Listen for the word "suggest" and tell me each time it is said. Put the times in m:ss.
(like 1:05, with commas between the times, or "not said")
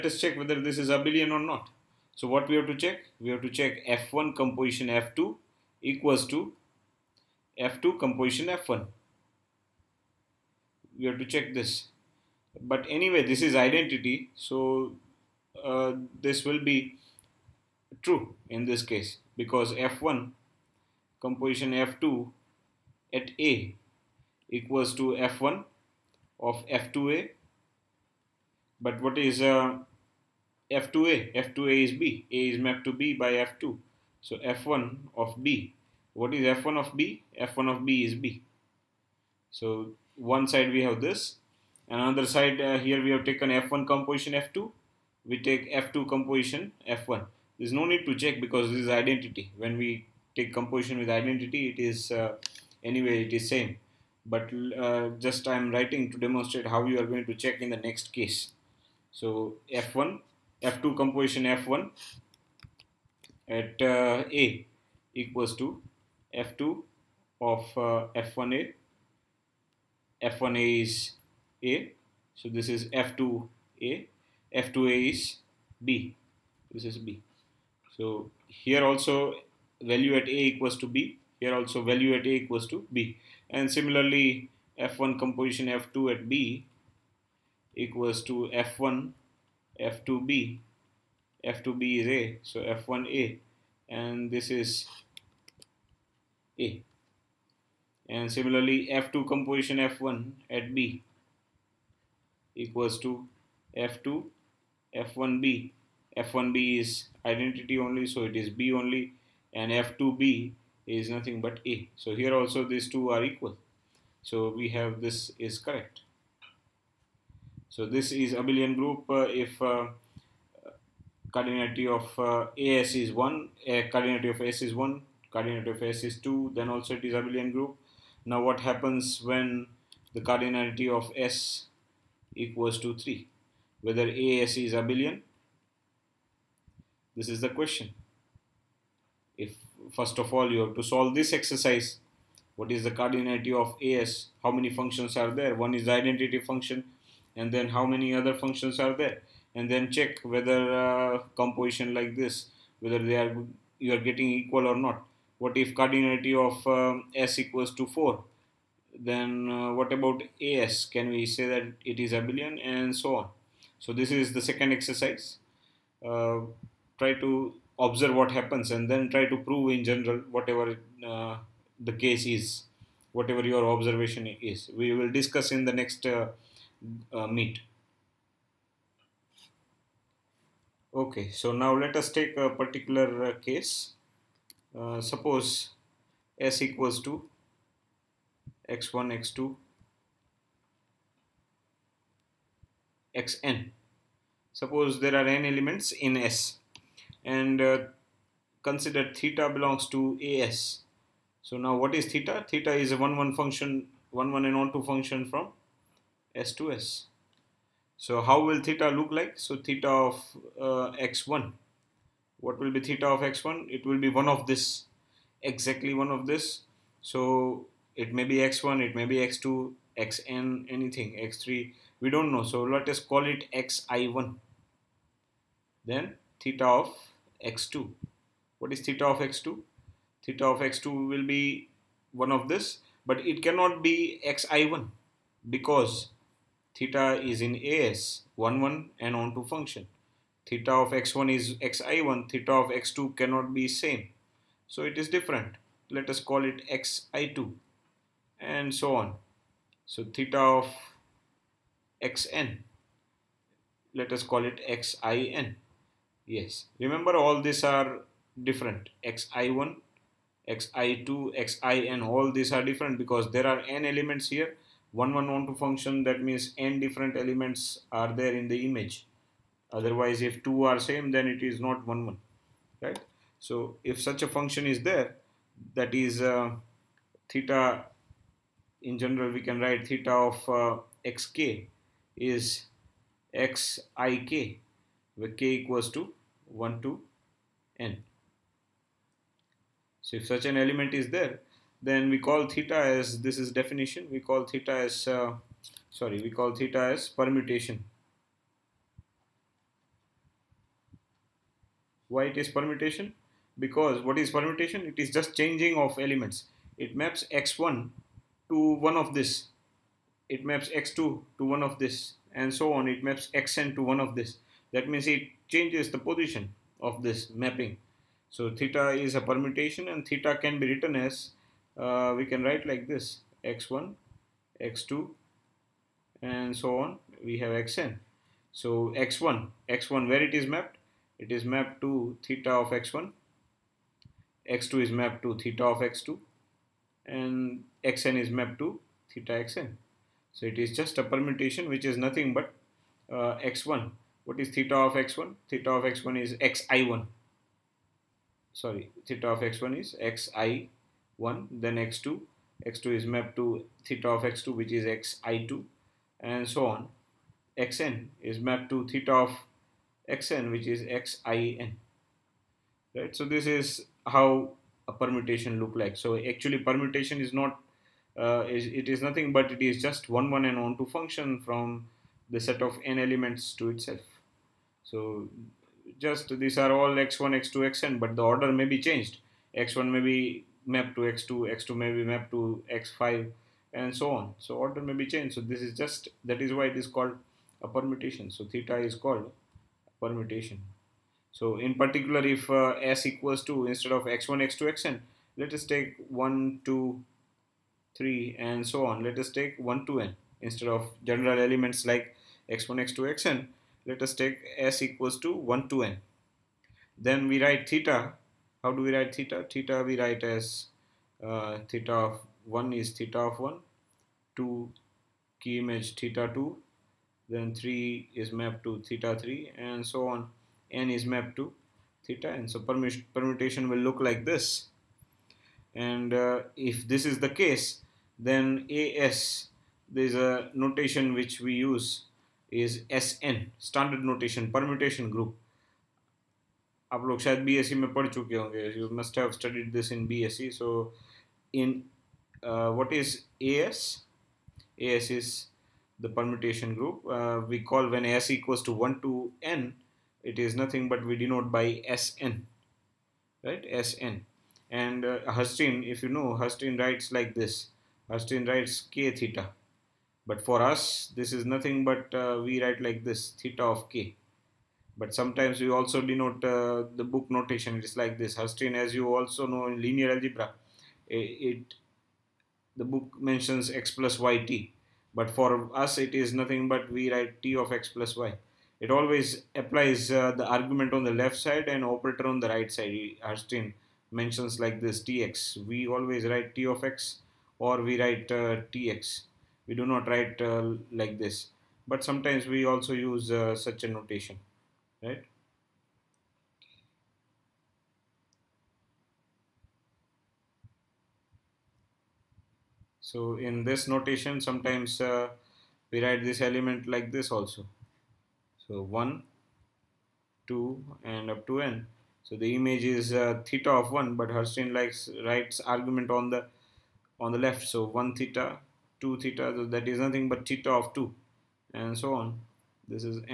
not said.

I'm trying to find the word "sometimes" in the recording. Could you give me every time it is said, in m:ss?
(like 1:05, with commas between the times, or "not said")
7:45, 8:12, 8:24.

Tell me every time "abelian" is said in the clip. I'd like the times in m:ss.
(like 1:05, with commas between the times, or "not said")
0:00, 1:58, 2:07, 2:14, 2:42.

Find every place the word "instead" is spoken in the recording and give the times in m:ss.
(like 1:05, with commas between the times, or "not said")
6:33, 6:40.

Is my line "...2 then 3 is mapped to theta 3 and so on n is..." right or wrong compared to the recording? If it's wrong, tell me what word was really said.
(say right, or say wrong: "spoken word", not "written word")
right.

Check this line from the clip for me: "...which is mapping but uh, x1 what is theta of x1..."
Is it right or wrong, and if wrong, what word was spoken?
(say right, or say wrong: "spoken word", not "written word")
wrong: "nothing", not "mapping".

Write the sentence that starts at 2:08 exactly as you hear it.
Now what happens when the cardinality of S equals to 3?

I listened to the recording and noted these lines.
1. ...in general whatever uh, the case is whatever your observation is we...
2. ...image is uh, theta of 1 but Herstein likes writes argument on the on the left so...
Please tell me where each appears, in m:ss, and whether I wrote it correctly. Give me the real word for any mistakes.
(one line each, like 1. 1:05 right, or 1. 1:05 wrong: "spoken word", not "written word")
1. 2:49 right
2. 8:32 right.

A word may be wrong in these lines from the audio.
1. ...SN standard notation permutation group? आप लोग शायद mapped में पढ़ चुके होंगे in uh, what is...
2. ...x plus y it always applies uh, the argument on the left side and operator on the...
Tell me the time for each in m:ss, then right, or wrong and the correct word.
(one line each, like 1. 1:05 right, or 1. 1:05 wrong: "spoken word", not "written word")
1. 7:12 wrong: "studied", not "mapped"
2. 7:57 right.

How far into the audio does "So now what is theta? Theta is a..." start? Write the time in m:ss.
3:21.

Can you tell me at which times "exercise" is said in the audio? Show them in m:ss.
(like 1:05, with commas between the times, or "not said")
2:21, 2:44.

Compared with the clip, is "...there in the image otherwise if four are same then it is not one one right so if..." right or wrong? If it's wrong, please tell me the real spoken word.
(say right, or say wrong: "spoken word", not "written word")
wrong: "two", not "four".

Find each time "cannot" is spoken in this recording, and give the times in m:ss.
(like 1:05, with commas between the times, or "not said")
3:53, 4:03.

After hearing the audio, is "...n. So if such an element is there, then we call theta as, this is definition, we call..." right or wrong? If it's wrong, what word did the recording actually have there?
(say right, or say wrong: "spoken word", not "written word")
right.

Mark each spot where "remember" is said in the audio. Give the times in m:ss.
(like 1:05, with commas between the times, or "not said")
4:16.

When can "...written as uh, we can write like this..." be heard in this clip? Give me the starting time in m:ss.
5:20.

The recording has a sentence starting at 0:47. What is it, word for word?
There's no need to check because this is identity.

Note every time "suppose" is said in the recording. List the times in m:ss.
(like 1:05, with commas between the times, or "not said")
3:05, 3:14.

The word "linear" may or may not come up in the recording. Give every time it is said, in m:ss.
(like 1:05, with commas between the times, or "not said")
7:49.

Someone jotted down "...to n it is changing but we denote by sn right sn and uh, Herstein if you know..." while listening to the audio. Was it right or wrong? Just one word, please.
wrong.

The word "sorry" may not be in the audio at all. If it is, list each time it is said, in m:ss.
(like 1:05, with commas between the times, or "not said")
4:55, 5:48.